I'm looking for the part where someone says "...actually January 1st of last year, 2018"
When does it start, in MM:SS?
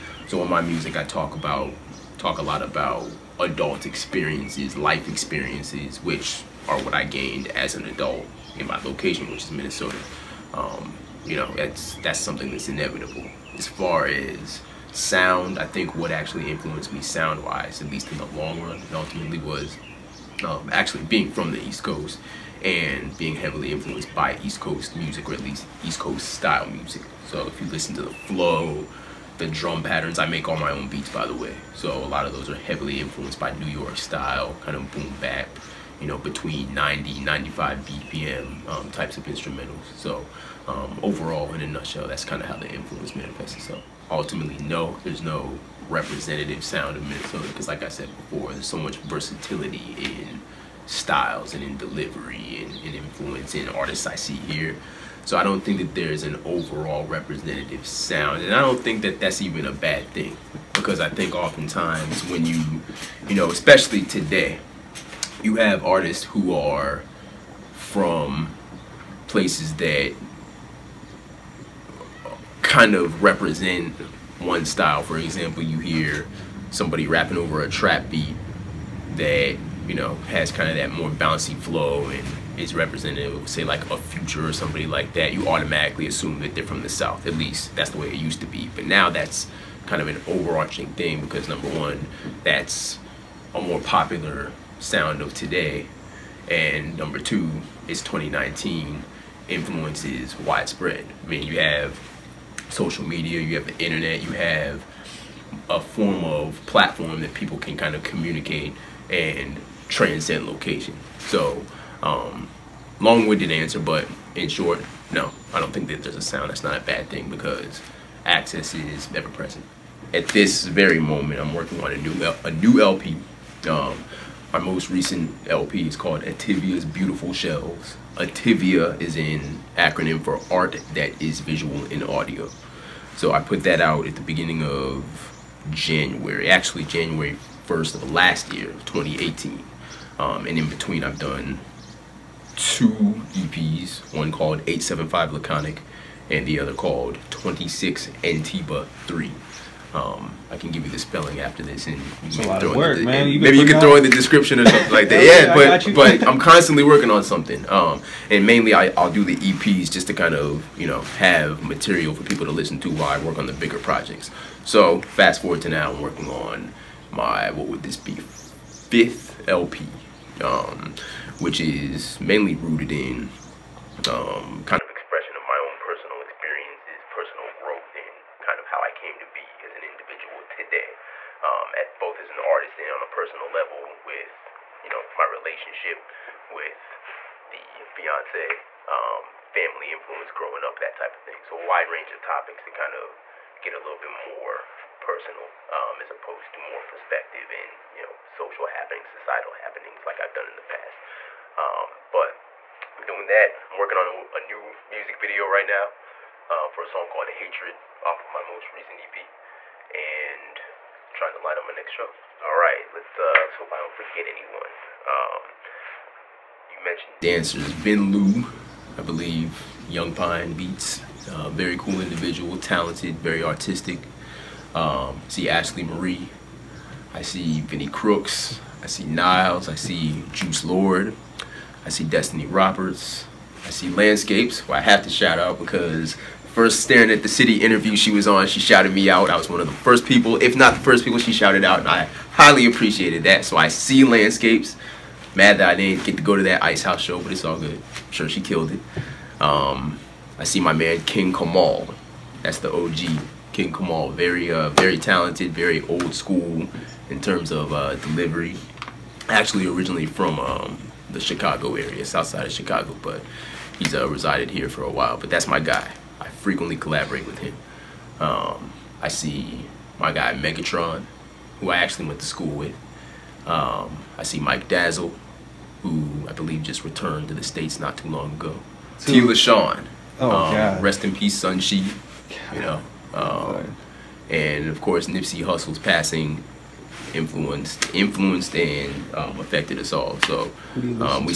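02:16.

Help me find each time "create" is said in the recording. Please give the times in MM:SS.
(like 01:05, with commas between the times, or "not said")
not said.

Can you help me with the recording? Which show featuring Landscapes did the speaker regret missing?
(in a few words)
Ice House.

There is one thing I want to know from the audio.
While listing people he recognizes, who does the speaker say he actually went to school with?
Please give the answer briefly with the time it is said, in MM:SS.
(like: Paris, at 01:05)
Megatron, at 04:30.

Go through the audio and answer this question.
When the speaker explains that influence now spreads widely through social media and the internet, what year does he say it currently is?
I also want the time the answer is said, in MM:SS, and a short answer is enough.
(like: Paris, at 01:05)
2019, at 01:37.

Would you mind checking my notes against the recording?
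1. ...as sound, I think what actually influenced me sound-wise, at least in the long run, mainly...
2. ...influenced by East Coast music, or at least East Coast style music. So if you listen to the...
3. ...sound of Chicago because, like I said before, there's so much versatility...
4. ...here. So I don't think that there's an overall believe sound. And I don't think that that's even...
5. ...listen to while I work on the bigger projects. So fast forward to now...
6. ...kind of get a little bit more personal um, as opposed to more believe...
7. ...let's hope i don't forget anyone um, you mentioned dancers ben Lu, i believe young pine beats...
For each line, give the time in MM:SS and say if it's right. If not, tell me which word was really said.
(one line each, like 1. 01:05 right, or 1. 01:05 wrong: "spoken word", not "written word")
1. 00:14 wrong: "ultimately", not "mainly"
2. 00:23 right
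3. 00:46 wrong: "Minnesota", not "Chicago"
4. 00:54 wrong: "representative", not "believe"
5. 02:42 right
6. 03:12 wrong: "perspective", not "believe"
7. 03:33 right.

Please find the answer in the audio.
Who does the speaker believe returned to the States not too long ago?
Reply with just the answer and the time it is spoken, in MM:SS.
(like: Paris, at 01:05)
Mike Dazzle, at 04:34.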